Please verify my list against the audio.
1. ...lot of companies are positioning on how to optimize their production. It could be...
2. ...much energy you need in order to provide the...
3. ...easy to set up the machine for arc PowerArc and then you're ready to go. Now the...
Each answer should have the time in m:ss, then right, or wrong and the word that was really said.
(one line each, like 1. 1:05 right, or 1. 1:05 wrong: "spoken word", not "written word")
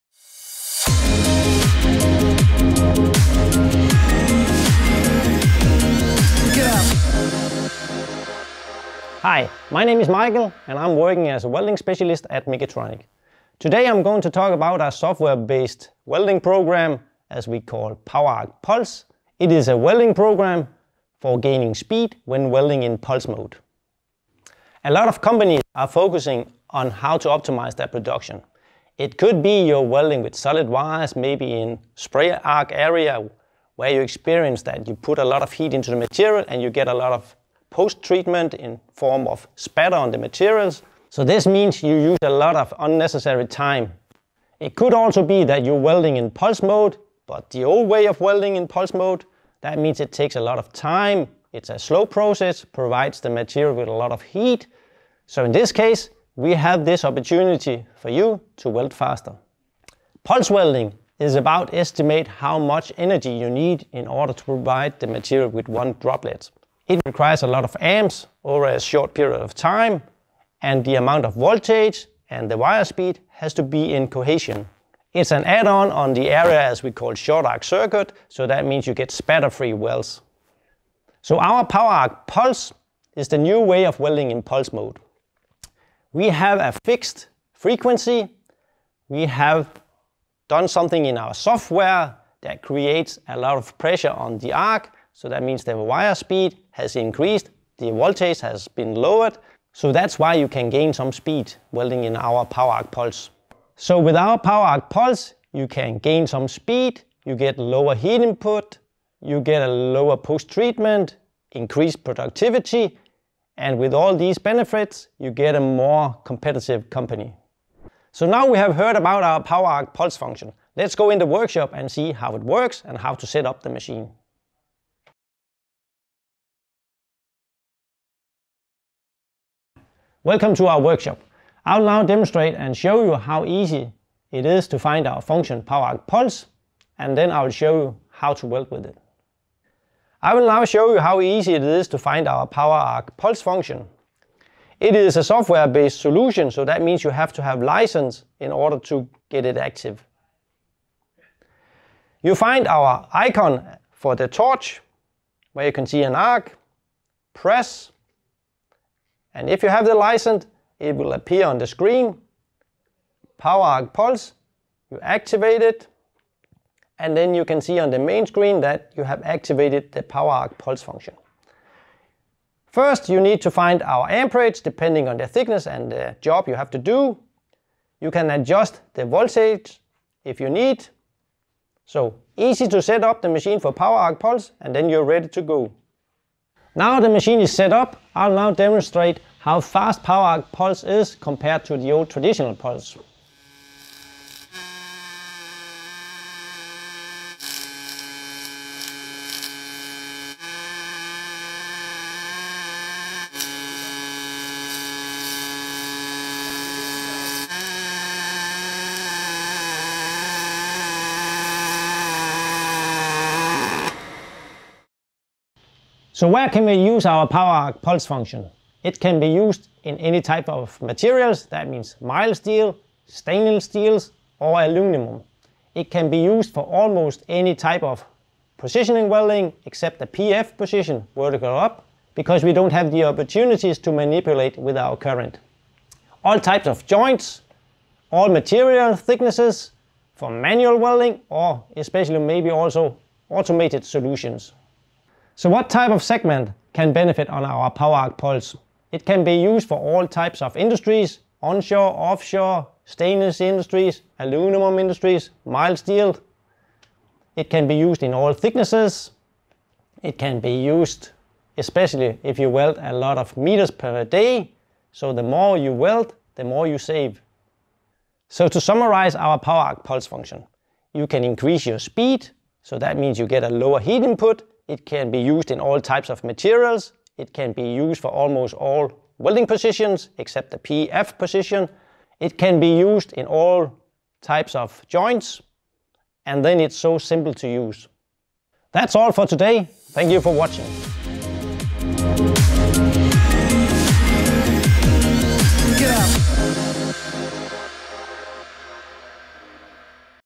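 1. 0:24 wrong: "focusing", not "positioning"
2. 1:02 right
3. 3:02 wrong: "Pulse", not "PowerArc".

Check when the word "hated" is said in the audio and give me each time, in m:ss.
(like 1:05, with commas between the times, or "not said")
not said.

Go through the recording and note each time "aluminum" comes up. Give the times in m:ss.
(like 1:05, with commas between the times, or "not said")
3:44, 4:14.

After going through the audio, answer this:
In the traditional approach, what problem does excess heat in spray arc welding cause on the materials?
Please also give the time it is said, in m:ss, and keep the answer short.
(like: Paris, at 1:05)
spatter, at 0:39.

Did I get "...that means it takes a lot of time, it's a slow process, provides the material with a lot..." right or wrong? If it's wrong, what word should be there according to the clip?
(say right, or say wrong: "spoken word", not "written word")
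right.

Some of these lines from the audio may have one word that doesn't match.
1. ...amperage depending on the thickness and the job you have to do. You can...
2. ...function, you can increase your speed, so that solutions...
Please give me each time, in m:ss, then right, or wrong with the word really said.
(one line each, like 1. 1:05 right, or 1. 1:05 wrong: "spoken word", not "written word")
1. 2:54 right
2. 4:30 wrong: "means", not "solutions".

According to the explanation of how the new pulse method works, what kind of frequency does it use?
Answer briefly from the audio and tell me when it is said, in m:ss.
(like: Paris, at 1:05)
fixed frequency, at 1:26.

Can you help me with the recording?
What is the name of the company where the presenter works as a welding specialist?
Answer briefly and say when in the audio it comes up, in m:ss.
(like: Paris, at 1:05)
Migatronic, at 0:12.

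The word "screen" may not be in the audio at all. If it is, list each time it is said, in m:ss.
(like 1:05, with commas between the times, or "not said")
2:41, 2:48.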